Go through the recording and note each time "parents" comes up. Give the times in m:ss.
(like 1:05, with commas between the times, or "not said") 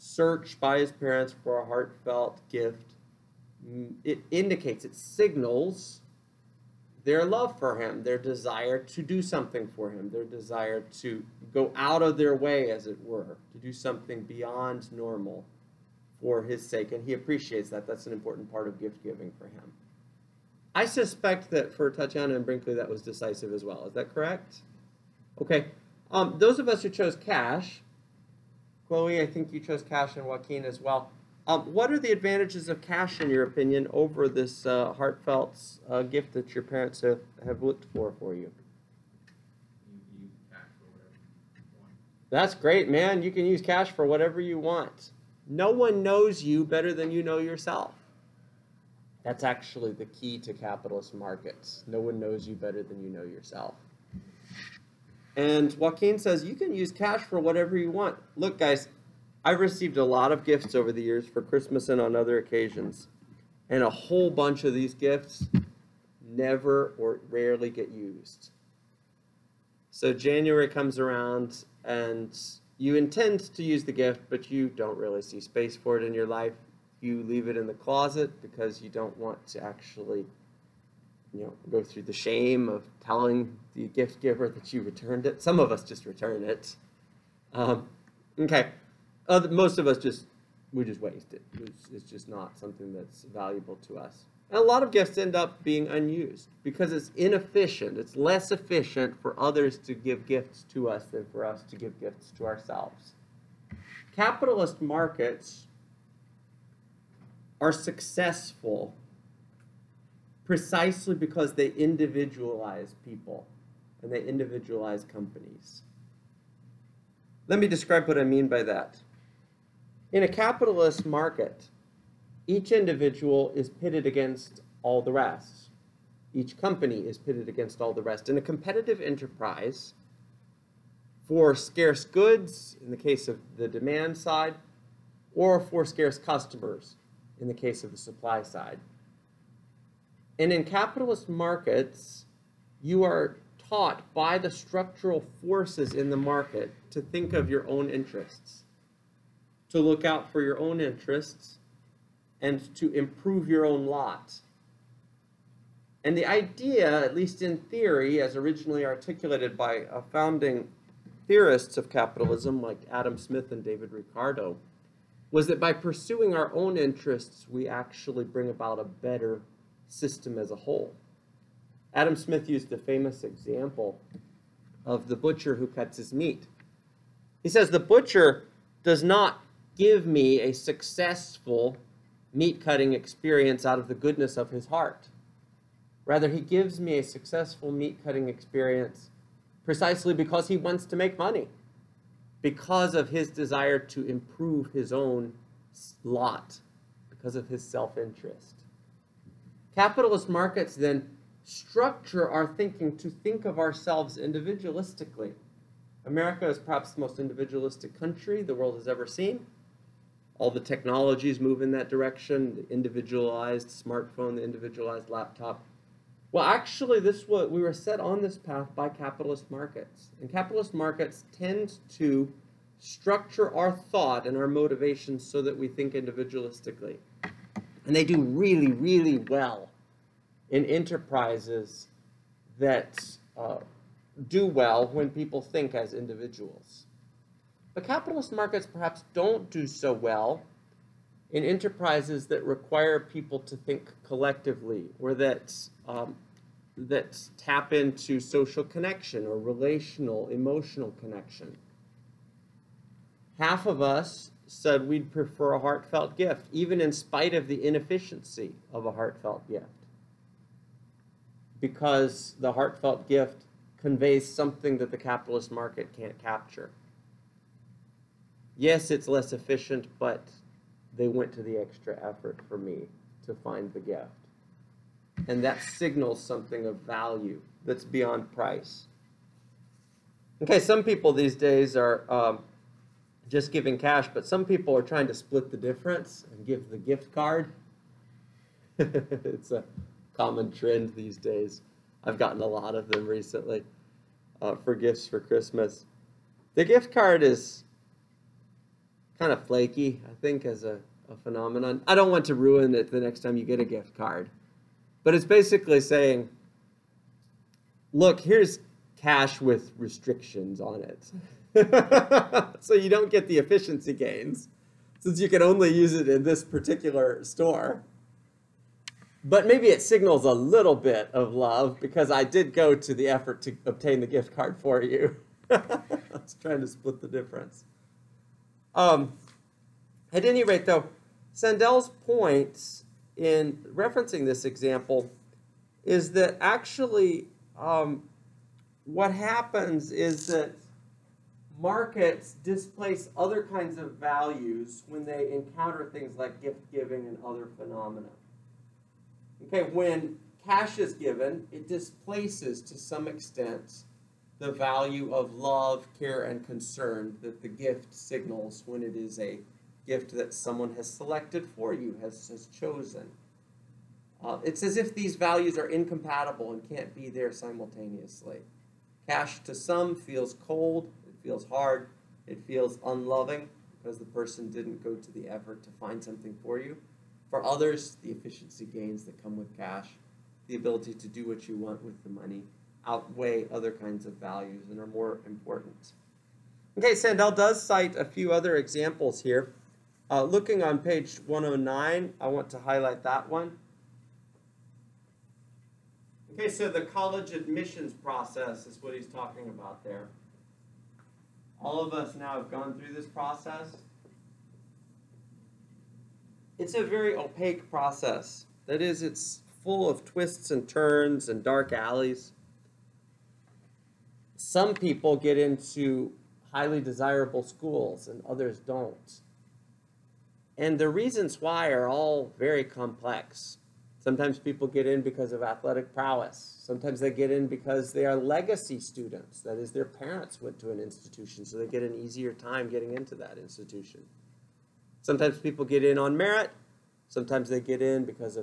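0:00, 0:36, 7:09.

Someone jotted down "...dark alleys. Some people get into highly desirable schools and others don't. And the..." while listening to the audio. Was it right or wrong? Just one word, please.
right.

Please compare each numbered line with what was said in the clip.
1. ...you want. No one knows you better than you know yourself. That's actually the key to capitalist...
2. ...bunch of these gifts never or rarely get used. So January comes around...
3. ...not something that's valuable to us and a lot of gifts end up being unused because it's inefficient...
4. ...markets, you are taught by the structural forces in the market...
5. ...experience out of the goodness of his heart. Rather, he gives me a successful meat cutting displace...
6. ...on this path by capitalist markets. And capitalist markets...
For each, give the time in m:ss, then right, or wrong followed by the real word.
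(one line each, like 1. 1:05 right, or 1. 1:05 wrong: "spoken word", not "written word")
1. 0:44 right
2. 1:04 right
3. 1:32 right
4. 2:21 right
5. 3:02 wrong: "experience", not "displace"
6. 3:37 right.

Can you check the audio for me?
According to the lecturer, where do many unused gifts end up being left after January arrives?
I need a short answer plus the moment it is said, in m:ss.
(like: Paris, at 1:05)
in the closet, at 1:17.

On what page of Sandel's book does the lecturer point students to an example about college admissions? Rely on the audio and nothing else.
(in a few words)
109.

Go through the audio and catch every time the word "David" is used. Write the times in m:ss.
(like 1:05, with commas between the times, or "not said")
2:43.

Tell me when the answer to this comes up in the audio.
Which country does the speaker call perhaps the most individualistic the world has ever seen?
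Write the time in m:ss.
3:26.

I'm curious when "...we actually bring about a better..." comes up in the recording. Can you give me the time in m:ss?
2:47.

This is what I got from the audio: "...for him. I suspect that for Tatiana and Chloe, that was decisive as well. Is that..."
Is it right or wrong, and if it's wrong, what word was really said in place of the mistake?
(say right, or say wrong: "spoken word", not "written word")
wrong: "Brinkley", not "Chloe".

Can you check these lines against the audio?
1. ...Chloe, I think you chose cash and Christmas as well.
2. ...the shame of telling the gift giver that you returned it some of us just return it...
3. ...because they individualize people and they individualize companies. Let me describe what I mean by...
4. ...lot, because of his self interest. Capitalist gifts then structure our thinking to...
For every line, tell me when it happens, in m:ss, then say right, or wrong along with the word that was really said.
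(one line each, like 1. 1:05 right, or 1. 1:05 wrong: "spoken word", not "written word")
1. 0:28 wrong: "Joaquin", not "Christmas"
2. 1:22 right
3. 1:51 right
4. 3:16 wrong: "markets", not "gifts".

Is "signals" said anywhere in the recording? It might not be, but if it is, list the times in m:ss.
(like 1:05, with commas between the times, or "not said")
0:04, 4:35, 5:19, 5:57.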